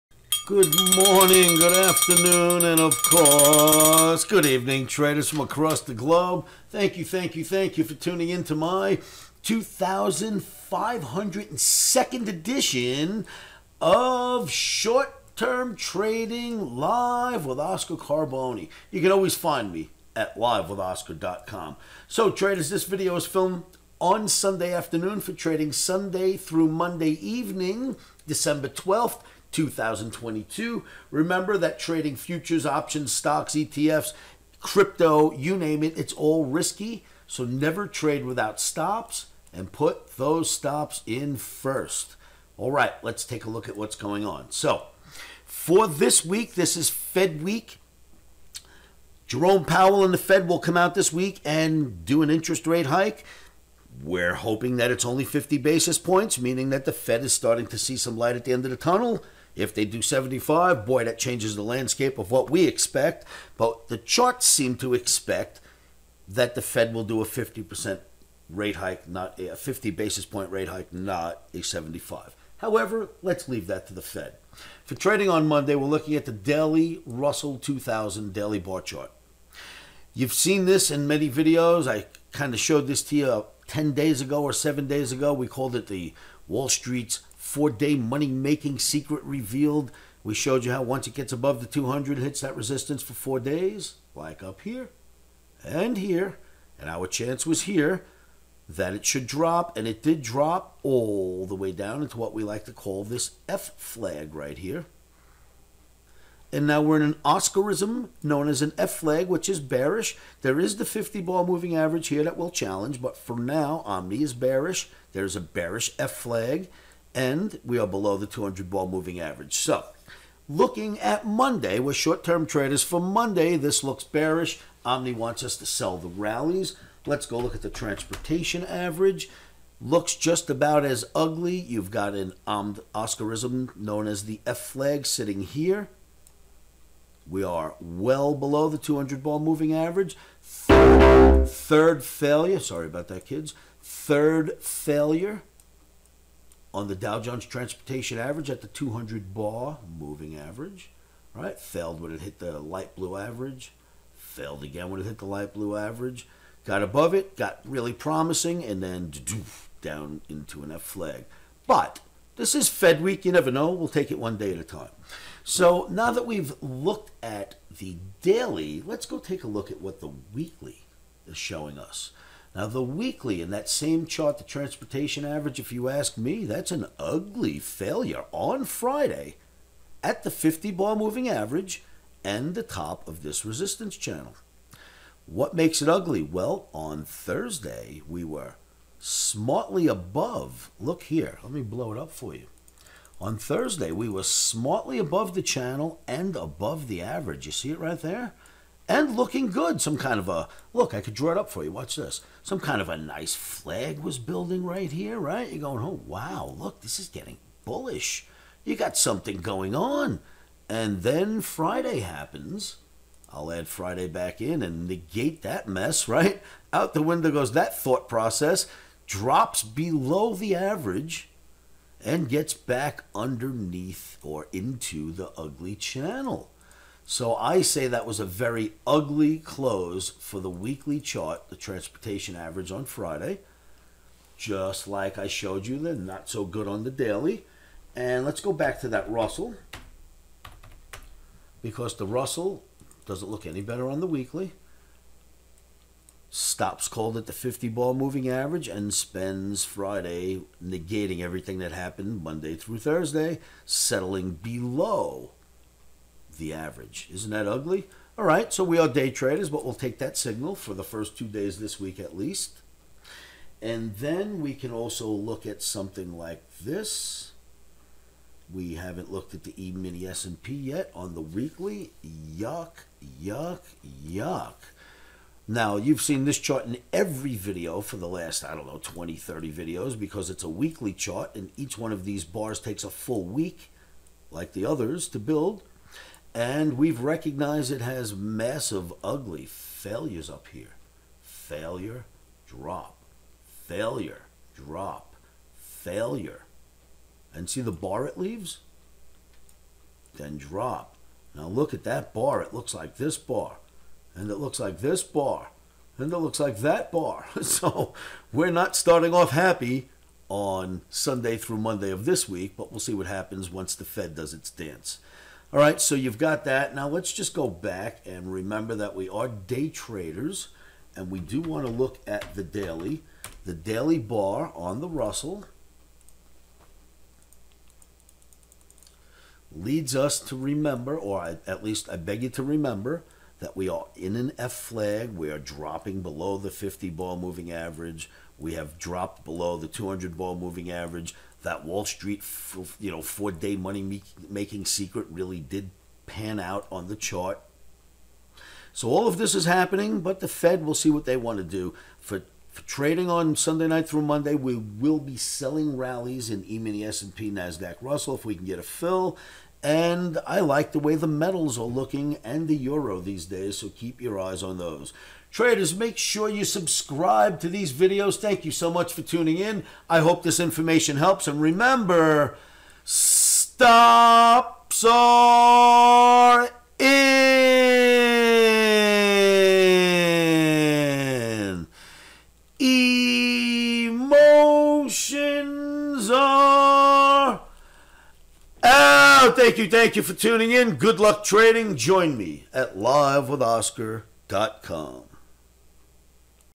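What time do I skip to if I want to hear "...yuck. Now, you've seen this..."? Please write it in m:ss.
4:34.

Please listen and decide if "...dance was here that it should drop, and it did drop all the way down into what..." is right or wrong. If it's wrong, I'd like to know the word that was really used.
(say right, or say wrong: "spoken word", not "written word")
wrong: "chance", not "dance".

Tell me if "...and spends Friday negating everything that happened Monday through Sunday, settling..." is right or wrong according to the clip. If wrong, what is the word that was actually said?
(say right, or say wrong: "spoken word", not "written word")
wrong: "Thursday", not "Sunday".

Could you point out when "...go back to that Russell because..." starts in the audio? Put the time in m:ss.
3:58.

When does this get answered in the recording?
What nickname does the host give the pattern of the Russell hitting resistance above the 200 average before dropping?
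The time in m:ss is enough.
1:26.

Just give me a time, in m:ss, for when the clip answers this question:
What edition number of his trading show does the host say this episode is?
0:09.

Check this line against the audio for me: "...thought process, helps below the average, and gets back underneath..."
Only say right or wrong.
wrong.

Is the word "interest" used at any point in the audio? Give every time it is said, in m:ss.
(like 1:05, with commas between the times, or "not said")
0:52.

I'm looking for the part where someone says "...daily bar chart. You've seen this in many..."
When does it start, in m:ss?
1:18.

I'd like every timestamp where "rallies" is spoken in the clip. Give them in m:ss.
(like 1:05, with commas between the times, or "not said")
2:06, 5:55.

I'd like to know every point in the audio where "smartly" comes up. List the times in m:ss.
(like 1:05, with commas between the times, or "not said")
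3:08, 3:14.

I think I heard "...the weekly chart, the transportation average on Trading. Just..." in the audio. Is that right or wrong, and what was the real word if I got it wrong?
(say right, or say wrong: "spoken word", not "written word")
wrong: "Friday", not "Trading".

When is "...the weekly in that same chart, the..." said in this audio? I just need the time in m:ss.
2:52.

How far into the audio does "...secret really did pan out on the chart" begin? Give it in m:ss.
5:44.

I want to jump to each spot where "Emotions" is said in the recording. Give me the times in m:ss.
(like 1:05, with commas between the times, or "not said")
6:22.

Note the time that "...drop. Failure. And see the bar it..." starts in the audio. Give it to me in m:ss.
4:54.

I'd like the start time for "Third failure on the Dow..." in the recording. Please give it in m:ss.
2:23.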